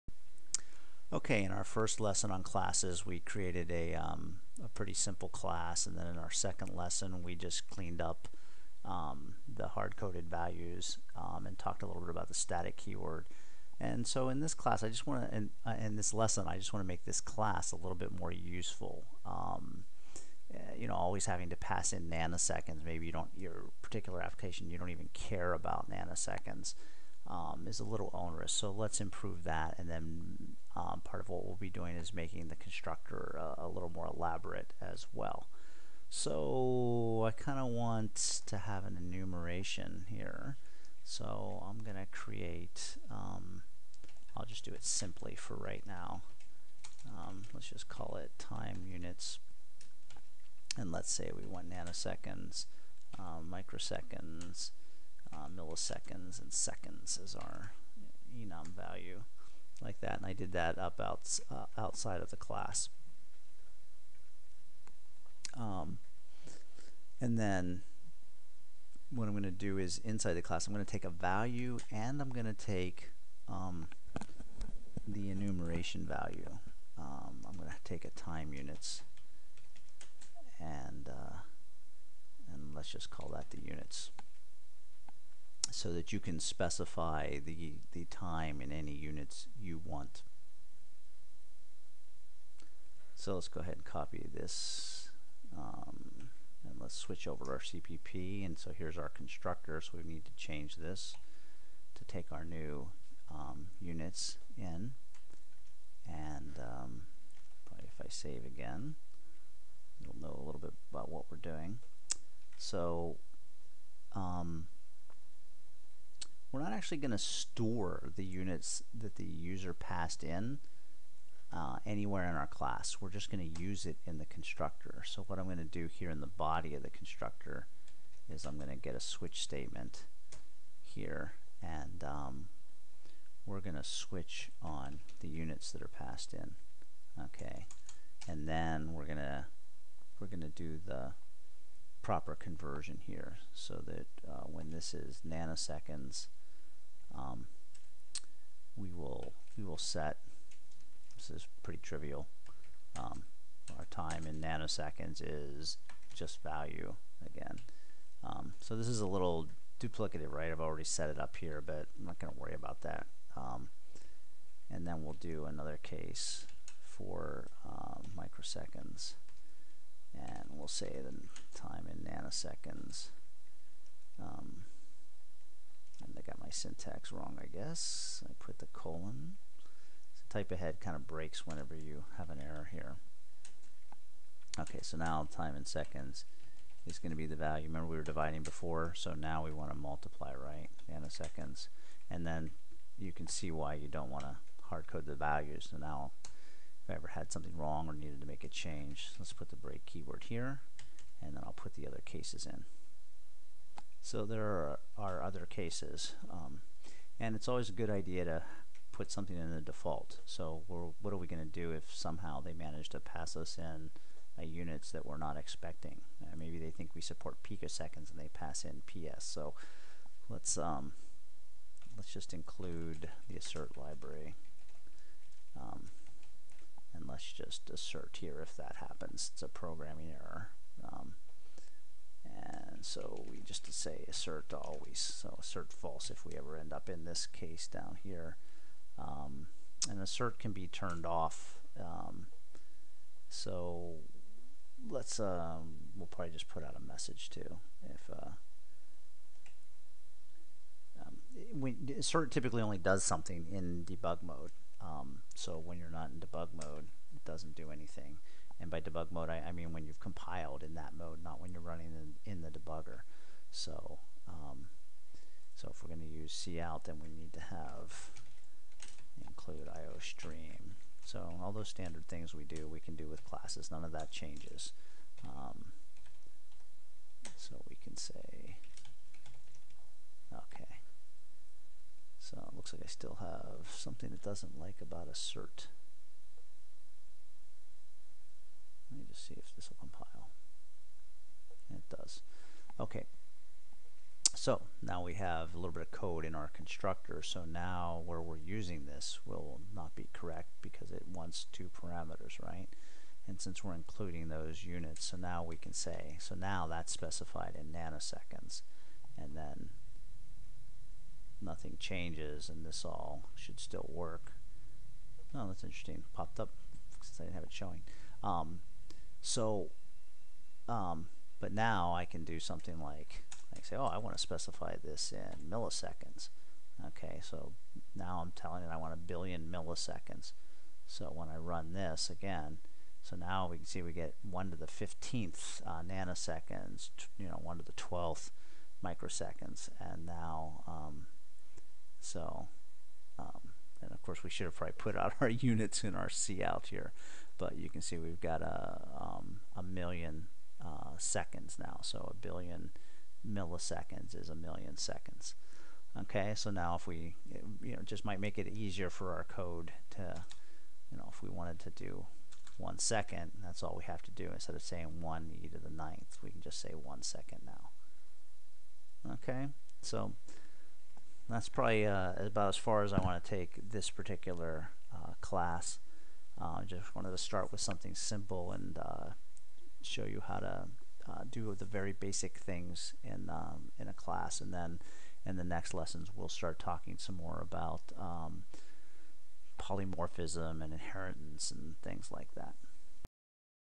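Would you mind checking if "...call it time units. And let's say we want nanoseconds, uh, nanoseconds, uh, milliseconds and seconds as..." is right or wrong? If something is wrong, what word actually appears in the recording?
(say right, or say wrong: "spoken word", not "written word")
wrong: "microseconds", not "nanoseconds".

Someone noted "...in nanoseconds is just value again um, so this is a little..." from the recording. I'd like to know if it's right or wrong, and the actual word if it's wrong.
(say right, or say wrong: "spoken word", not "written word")
right.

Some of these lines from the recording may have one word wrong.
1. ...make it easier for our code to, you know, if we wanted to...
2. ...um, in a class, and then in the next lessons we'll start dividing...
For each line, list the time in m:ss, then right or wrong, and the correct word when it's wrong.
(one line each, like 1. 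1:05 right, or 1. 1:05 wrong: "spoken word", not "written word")
1. 5:58 right
2. 6:23 wrong: "talking", not "dividing".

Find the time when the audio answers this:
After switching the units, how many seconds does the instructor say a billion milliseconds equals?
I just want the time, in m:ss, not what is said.
5:54.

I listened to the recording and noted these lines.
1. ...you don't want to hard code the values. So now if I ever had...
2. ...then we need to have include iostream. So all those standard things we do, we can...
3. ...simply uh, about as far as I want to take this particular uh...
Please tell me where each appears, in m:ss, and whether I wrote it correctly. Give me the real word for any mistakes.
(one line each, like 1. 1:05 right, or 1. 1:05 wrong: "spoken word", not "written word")
1. 3:13 right
2. 4:26 right
3. 6:11 wrong: "probably", not "simply".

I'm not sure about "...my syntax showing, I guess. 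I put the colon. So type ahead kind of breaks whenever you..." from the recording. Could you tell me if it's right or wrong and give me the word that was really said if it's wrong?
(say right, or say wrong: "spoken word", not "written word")
wrong: "wrong", not "showing".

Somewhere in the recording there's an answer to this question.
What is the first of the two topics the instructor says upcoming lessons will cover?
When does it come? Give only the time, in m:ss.
6:29.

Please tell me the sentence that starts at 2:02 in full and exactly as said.
We're just going to use it in the constructor.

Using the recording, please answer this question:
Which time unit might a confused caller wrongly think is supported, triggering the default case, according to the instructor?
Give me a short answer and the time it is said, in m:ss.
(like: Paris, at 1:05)
picoseconds, at 3:37.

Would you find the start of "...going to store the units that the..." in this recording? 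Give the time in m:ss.
1:56.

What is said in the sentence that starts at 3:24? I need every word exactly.
So there are, are other cases.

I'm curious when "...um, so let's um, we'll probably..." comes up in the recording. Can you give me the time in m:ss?
4:01.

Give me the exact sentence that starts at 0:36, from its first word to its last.
So I kind of want to have an enumeration here.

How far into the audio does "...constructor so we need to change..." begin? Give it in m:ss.
1:39.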